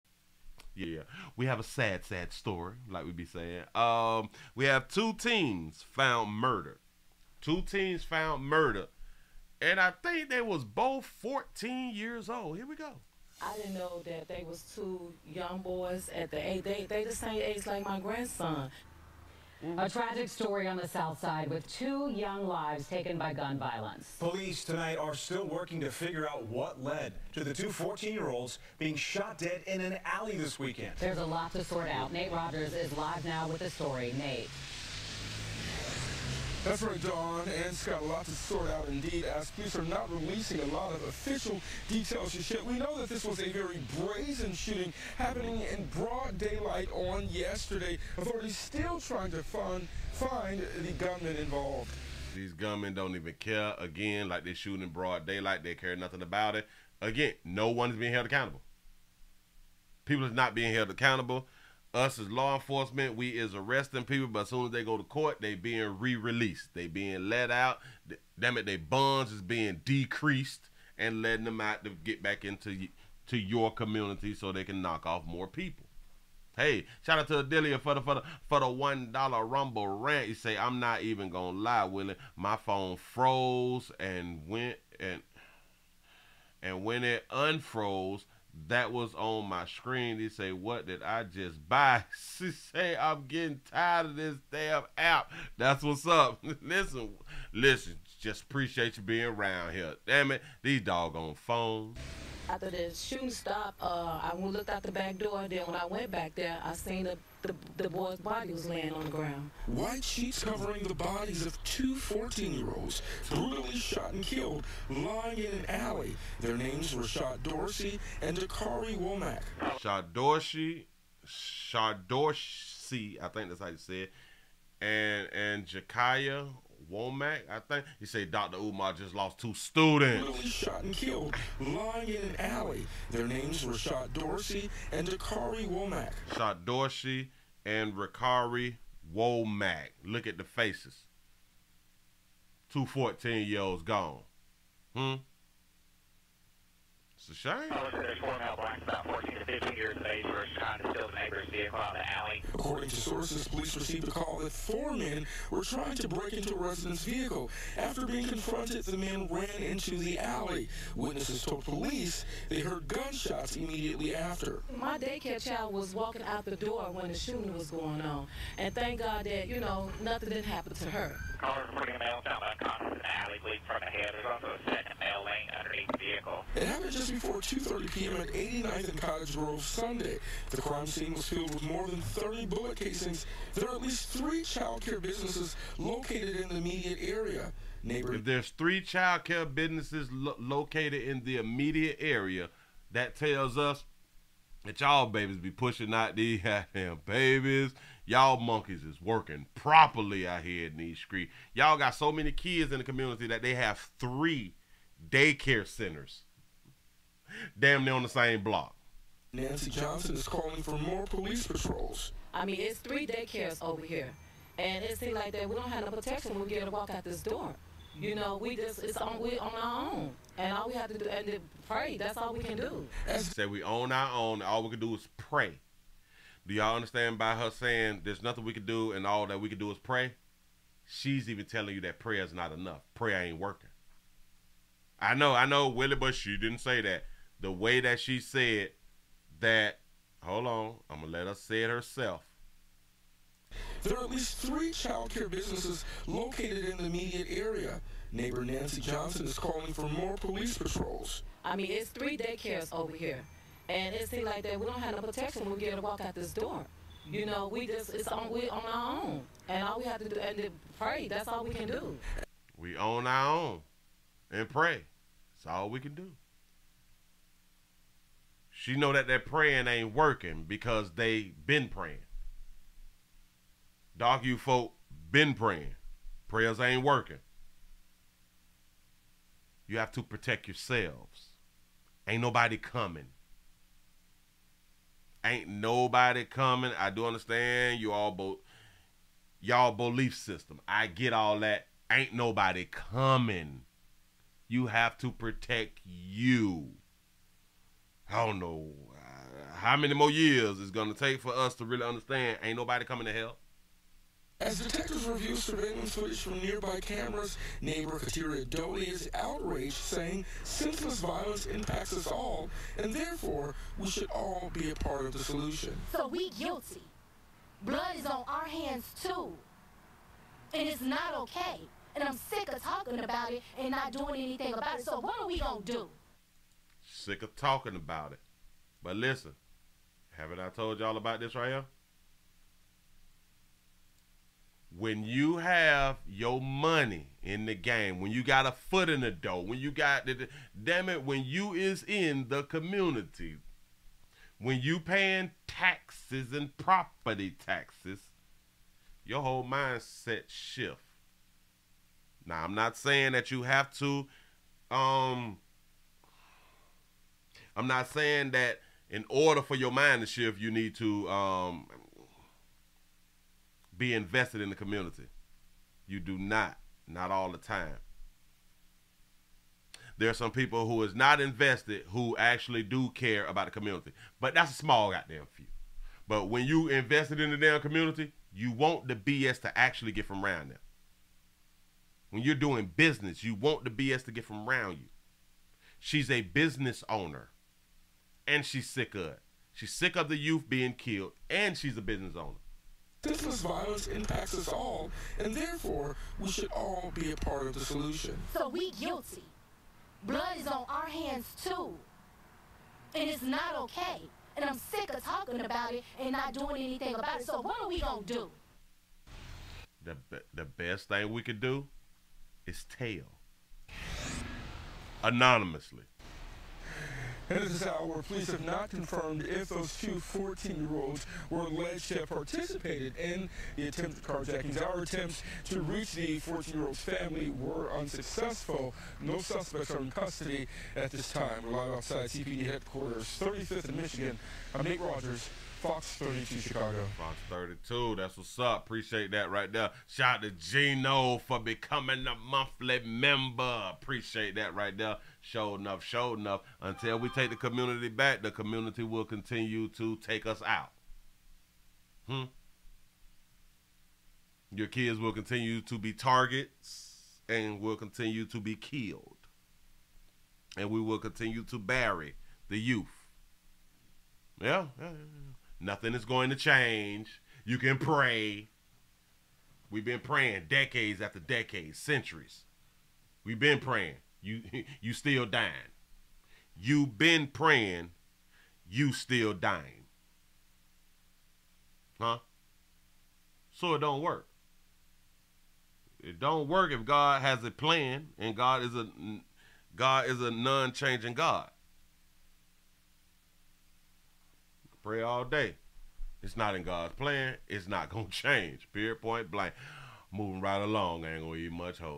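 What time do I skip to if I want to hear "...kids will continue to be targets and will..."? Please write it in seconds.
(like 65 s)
454 s.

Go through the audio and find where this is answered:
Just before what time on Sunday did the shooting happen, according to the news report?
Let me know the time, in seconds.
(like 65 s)
177 s.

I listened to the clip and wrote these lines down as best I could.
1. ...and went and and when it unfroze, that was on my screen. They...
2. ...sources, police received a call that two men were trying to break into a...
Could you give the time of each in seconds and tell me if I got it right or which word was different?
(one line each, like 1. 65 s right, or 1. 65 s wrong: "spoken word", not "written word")
1. 83 s right
2. 153 s wrong: "four", not "two".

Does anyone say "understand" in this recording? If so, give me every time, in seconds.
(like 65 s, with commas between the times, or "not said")
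226 s, 287 s, 301 s.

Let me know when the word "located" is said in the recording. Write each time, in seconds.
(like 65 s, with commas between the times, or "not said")
185 s, 190 s, 246 s.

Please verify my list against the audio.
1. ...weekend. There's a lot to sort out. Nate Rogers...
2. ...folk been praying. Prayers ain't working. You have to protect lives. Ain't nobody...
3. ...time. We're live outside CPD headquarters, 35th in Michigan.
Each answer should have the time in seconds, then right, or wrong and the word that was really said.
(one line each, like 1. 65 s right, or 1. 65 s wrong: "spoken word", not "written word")
1. 30 s right
2. 274 s wrong: "yourselves", not "lives"
3. 431 s right.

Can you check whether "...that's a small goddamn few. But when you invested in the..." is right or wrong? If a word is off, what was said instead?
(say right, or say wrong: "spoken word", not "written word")
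right.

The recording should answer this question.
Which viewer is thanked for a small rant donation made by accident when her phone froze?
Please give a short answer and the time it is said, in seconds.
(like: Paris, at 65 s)
Adelia, at 77 s.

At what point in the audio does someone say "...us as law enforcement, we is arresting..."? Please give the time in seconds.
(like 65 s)
61 s.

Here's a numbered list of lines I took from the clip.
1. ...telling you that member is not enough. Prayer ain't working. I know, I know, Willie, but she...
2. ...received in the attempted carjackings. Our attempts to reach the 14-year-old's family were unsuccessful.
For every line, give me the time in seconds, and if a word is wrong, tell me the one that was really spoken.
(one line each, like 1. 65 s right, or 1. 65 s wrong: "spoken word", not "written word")
1. 231 s wrong: "prayer", not "member"
2. 422 s wrong: "participated", not "received".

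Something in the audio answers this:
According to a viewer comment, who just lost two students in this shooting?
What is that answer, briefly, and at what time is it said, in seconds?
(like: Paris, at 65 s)
Dr. Umar, at 128 s.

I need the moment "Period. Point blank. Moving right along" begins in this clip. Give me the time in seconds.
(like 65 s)
498 s.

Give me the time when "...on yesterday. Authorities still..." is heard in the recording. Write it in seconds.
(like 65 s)
46 s.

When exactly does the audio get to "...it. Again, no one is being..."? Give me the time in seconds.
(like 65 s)
56 s.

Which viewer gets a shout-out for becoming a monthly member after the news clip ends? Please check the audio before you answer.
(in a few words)
Gino.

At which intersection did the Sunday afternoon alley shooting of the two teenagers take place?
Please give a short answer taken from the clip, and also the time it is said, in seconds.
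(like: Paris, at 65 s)
89th and Cottage Grove, at 178 s.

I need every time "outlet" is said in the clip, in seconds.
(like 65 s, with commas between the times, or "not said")
not said.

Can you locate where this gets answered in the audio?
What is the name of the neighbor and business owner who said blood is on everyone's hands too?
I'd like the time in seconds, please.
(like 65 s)
307 s.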